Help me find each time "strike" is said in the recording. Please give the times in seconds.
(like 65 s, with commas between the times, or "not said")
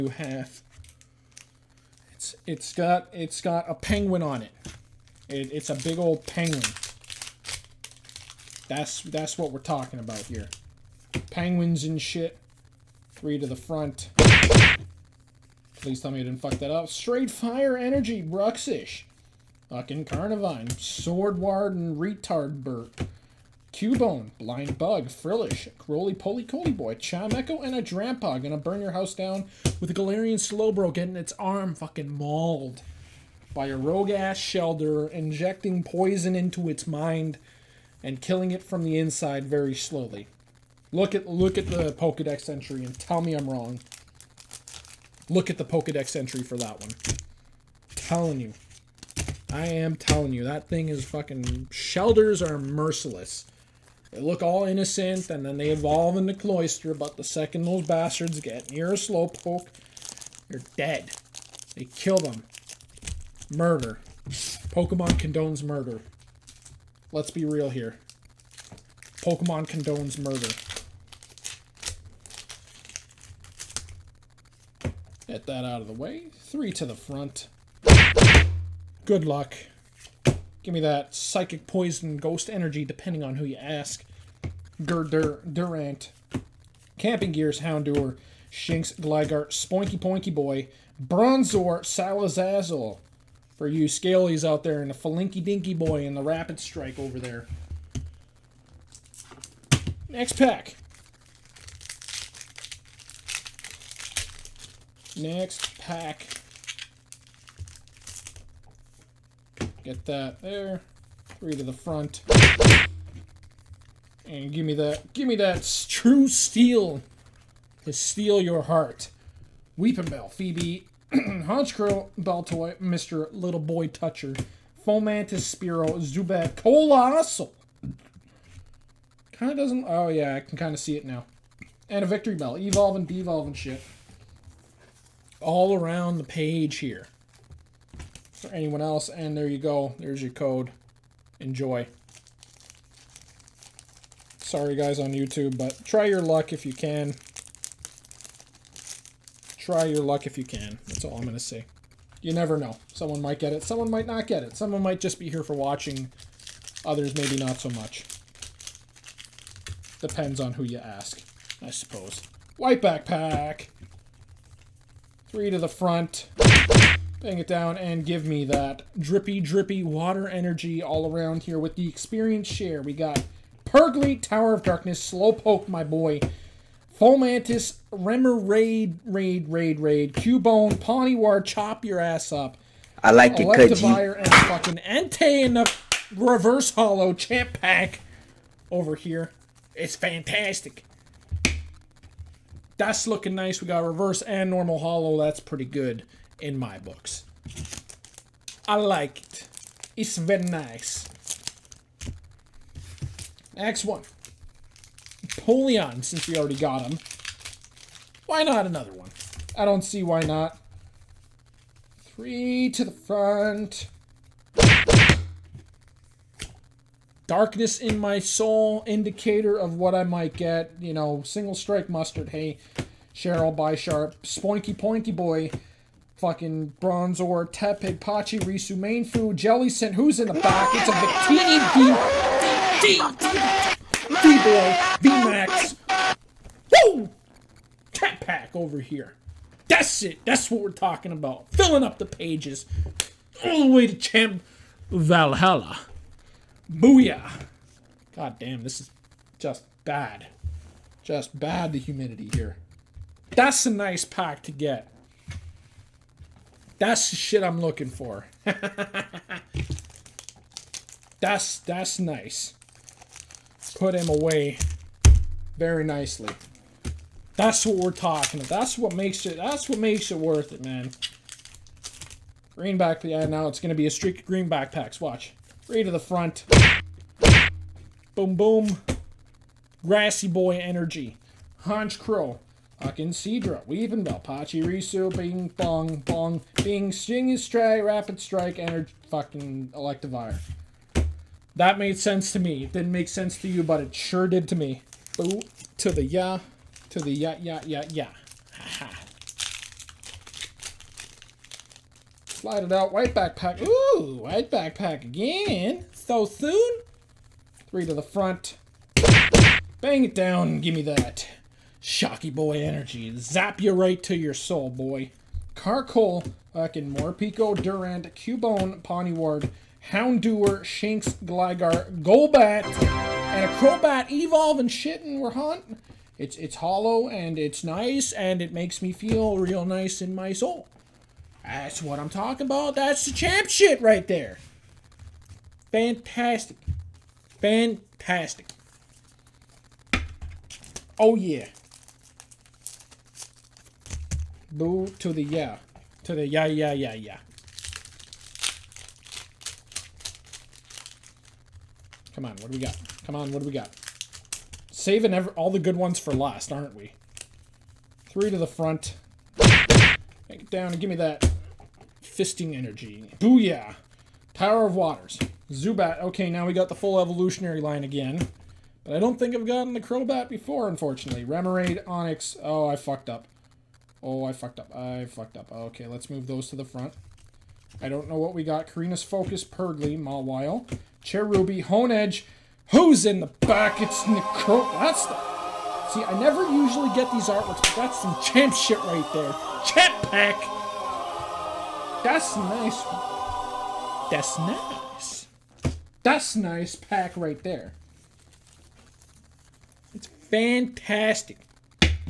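96 s, 221 s, 288 s.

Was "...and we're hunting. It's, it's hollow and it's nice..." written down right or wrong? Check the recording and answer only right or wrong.
right.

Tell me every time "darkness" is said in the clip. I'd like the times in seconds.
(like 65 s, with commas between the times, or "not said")
174 s, 217 s.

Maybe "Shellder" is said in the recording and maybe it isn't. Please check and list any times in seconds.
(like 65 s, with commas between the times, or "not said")
34 s, 51 s.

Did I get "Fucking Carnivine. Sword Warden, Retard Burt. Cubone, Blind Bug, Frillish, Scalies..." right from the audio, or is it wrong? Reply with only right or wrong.
wrong.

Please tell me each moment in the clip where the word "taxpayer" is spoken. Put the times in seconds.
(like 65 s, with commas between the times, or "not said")
not said.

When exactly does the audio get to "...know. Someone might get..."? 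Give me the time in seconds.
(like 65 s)
152 s.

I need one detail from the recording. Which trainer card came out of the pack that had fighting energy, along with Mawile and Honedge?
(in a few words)
Korrina's Focus.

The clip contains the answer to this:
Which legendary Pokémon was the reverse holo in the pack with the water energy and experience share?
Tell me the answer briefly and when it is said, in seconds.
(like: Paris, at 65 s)
Entei, at 184 s.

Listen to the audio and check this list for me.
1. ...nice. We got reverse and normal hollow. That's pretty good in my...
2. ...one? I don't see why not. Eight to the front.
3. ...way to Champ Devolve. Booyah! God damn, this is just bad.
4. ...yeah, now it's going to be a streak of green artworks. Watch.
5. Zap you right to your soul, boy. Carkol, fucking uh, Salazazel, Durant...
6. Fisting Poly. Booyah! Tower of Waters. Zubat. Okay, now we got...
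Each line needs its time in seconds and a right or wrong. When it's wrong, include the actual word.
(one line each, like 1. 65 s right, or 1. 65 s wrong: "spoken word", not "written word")
1. 193 s right
2. 208 s wrong: "Three", not "Eight"
3. 243 s wrong: "Valhalla", not "Devolve"
4. 273 s wrong: "backpacks", not "artworks"
5. 313 s wrong: "Morpeko", not "Salazazel"
6. 362 s wrong: "Energy", not "Poly".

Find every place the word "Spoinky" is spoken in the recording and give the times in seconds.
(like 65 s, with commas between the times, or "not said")
89 s, 224 s.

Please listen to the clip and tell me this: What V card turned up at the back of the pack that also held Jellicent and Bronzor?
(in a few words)
Victini V.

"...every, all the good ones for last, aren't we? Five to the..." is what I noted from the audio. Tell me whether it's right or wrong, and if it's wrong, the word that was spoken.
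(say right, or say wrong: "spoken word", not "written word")
wrong: "Three", not "Five".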